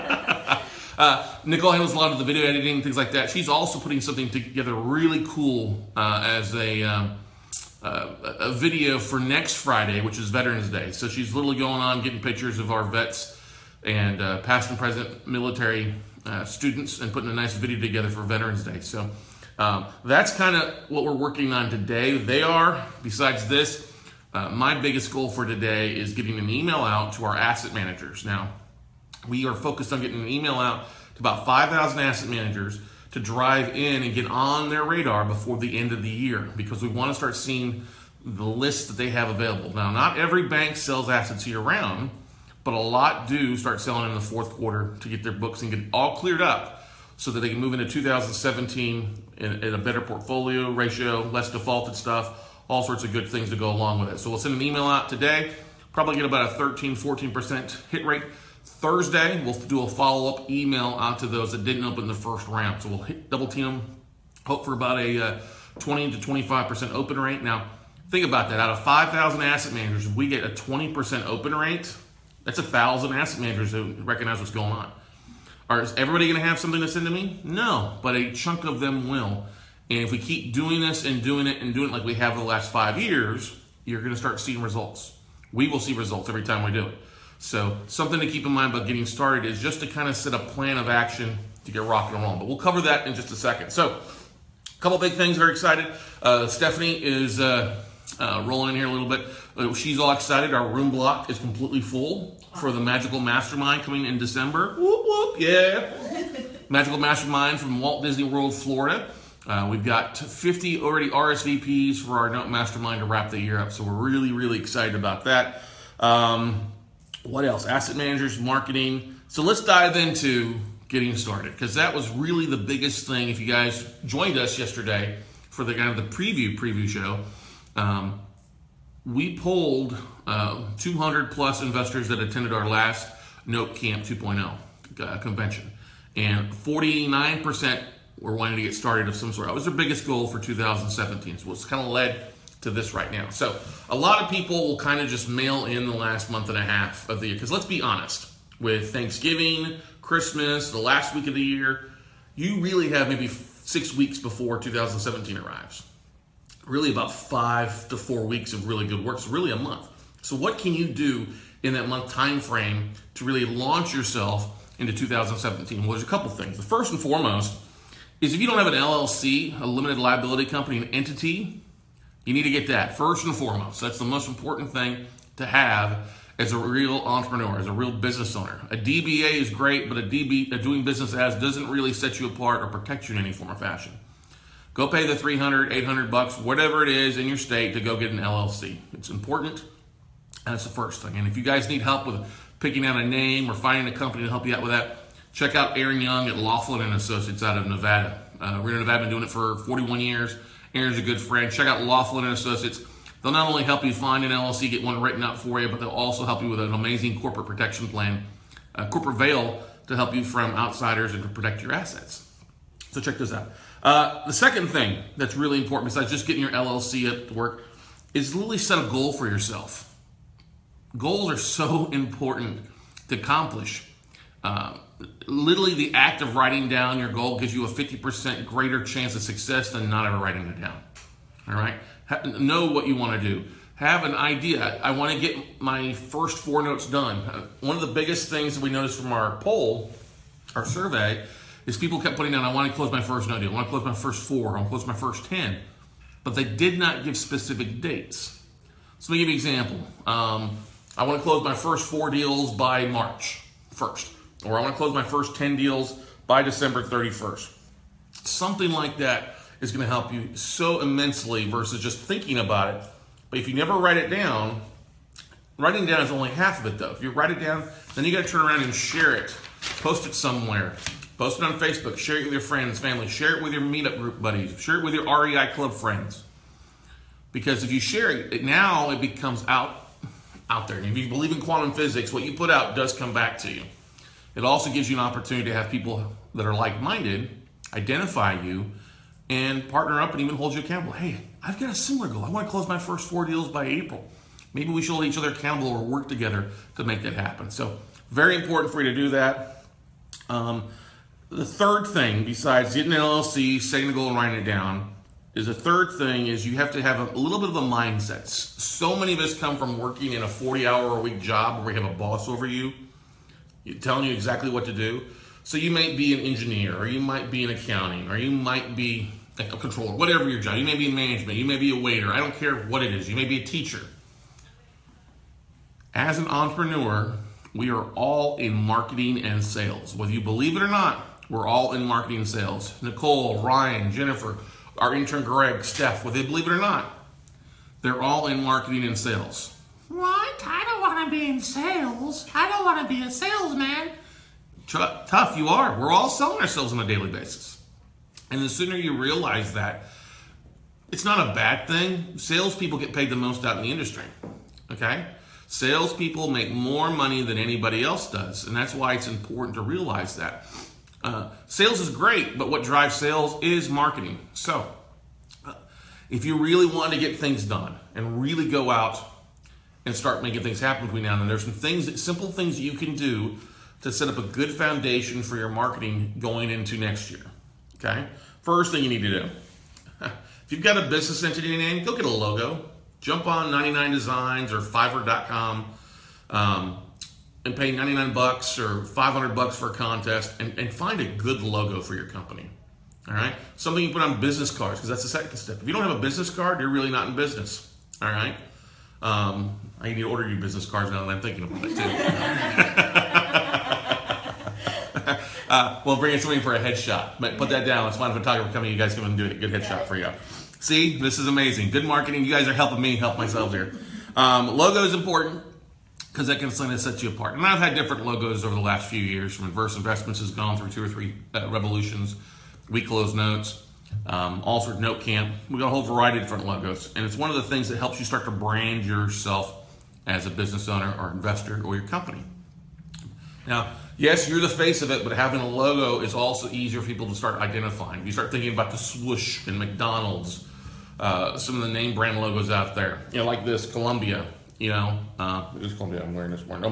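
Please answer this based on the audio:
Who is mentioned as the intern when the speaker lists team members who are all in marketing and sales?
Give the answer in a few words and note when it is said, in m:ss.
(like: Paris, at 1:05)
Greg, at 5:35.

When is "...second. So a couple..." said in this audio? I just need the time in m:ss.
1:33.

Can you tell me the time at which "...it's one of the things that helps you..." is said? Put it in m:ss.
7:07.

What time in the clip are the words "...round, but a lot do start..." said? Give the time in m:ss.
0:41.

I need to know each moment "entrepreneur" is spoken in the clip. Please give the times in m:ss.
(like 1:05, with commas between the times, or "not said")
2:56, 5:26.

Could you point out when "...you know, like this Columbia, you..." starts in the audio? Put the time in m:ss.
7:23.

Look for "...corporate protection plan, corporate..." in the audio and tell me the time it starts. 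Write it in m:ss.
3:27.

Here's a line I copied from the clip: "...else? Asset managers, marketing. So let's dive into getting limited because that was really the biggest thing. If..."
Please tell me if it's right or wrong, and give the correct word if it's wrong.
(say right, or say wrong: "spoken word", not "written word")
wrong: "started", not "limited".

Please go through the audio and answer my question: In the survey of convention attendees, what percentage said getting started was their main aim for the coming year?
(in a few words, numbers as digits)
49%.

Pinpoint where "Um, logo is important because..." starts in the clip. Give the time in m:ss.
6:54.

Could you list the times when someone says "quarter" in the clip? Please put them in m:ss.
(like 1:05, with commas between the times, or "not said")
0:44.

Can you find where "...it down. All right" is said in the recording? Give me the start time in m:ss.
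3:50.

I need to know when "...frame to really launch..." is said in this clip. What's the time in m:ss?
2:42.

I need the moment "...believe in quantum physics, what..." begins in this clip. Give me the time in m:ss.
4:41.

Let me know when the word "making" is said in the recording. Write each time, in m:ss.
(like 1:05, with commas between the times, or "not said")
6:10.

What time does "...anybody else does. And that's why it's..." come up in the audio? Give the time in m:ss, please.
5:57.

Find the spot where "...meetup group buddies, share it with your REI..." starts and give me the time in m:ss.
4:33.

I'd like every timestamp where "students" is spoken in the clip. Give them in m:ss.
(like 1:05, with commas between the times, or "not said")
0:16.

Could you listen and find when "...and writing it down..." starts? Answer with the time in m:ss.
5:04.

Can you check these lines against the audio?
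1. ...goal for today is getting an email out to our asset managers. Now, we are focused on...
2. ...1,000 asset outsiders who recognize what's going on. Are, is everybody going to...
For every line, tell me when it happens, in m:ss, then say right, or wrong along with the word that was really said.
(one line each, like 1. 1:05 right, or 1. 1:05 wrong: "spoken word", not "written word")
1. 0:25 right
2. 1:12 wrong: "managers", not "outsiders".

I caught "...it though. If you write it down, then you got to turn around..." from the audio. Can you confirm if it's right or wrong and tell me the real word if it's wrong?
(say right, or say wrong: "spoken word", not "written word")
right.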